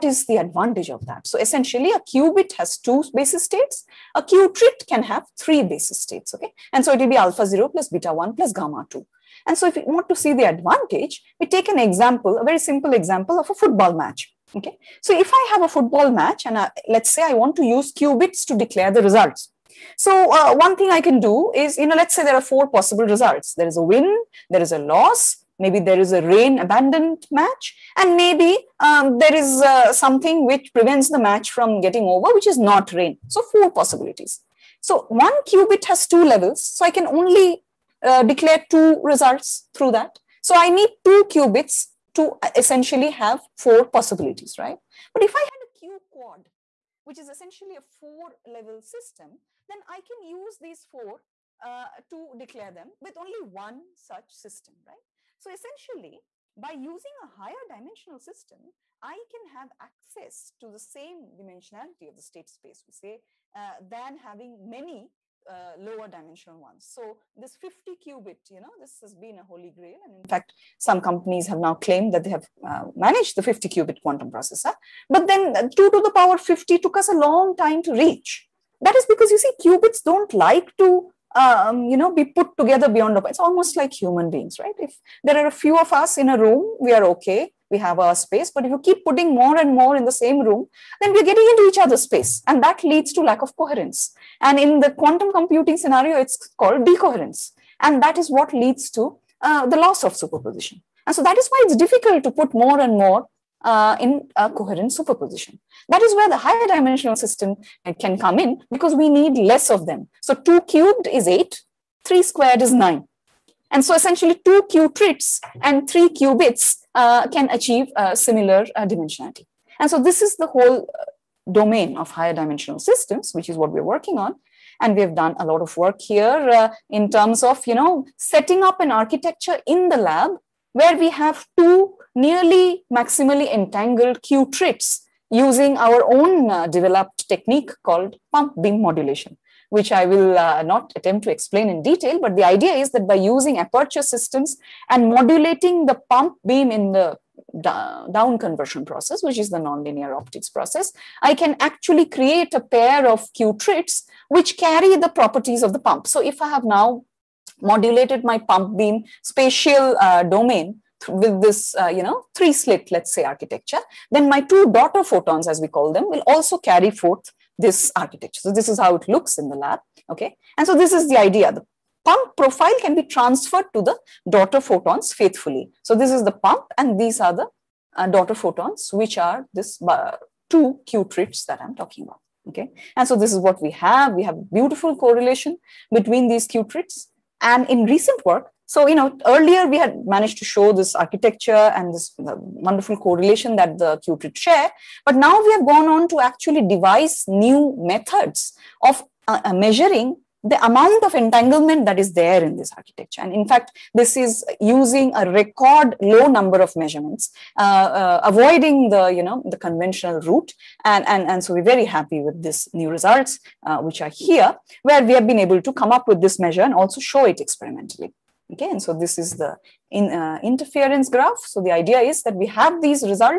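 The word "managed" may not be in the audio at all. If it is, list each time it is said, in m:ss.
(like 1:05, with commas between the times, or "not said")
1:12, 3:10.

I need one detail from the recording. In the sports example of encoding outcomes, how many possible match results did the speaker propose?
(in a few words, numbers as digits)
4.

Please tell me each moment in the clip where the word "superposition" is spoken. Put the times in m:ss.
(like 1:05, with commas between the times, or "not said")
1:40, 1:44.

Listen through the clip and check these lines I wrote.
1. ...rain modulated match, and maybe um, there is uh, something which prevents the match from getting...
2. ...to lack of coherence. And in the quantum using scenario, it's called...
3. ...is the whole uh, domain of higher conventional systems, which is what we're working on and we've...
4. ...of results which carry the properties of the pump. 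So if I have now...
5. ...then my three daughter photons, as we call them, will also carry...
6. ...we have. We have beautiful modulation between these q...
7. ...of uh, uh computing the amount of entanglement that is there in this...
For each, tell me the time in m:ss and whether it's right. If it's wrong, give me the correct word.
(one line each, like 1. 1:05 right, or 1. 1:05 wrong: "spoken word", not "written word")
1. 0:26 wrong: "abandoned", not "modulated"
2. 1:33 wrong: "computing", not "using"
3. 2:00 wrong: "dimensional", not "conventional"
4. 2:33 wrong: "qutrits", not "results"
5. 2:44 wrong: "two", not "three"
6. 3:03 wrong: "correlation", not "modulation"
7. 3:18 wrong: "measuring", not "computing".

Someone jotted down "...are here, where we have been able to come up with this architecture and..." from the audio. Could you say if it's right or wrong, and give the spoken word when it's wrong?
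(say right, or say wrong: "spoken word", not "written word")
wrong: "measure", not "architecture".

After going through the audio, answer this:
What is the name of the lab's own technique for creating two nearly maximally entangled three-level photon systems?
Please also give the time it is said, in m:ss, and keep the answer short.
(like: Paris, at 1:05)
pump beam modulation, at 2:18.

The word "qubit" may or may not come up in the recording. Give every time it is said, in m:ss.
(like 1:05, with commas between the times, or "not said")
0:02, 0:17, 0:35, 0:41, 1:07, 1:13, 1:19, 1:56.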